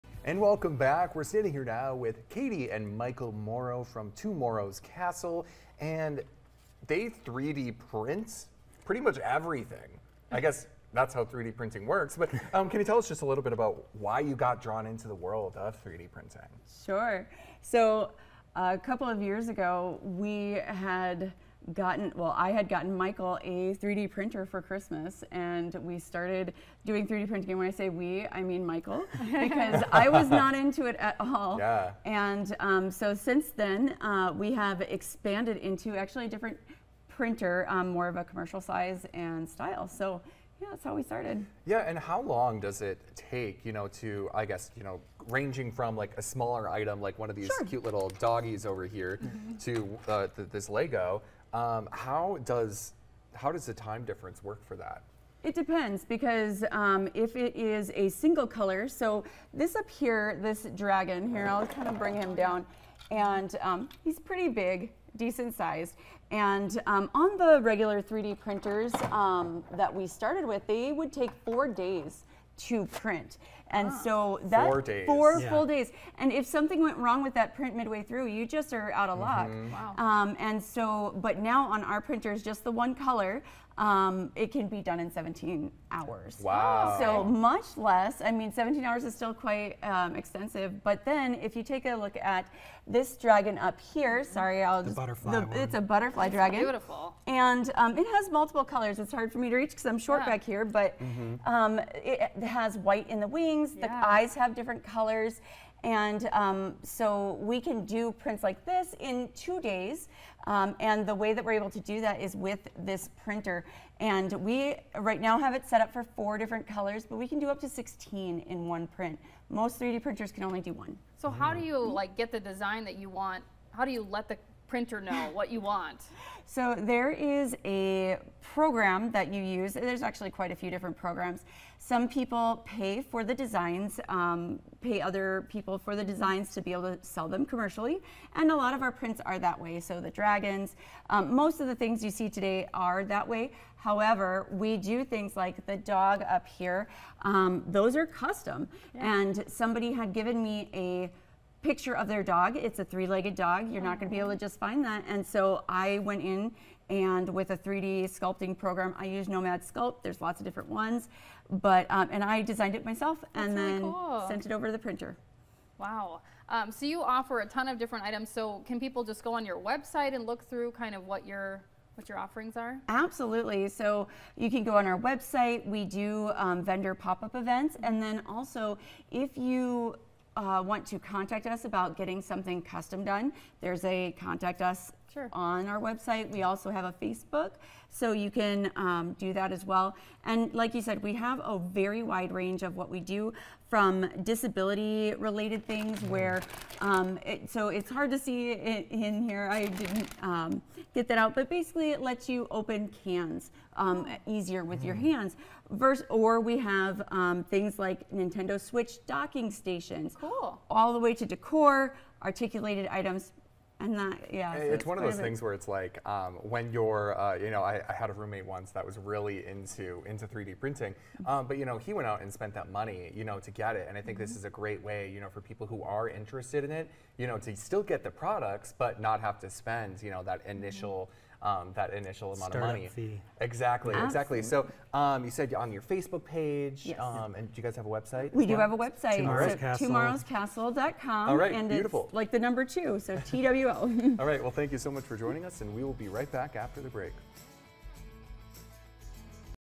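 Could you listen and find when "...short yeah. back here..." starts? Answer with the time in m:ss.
1:39.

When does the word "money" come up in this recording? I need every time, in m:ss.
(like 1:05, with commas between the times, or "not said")
3:42, 3:52.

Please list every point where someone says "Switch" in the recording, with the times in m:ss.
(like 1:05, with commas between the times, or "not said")
3:28.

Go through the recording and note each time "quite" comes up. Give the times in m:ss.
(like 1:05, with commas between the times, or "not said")
1:29, 2:10.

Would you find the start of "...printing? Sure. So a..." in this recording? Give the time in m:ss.
0:16.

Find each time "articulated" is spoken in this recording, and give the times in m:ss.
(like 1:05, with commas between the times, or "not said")
3:32.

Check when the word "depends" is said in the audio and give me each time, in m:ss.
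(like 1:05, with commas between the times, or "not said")
0:55.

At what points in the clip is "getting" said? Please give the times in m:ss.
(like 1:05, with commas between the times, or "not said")
3:01.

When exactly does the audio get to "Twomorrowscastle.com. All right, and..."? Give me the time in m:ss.
4:00.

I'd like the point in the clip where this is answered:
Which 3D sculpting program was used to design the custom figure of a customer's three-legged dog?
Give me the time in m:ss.
2:39.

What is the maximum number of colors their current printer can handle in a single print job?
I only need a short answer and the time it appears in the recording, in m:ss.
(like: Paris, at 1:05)
16, at 1:57.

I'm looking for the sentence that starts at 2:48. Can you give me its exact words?
So can people just go on your website and look through kind of what your what your offerings are?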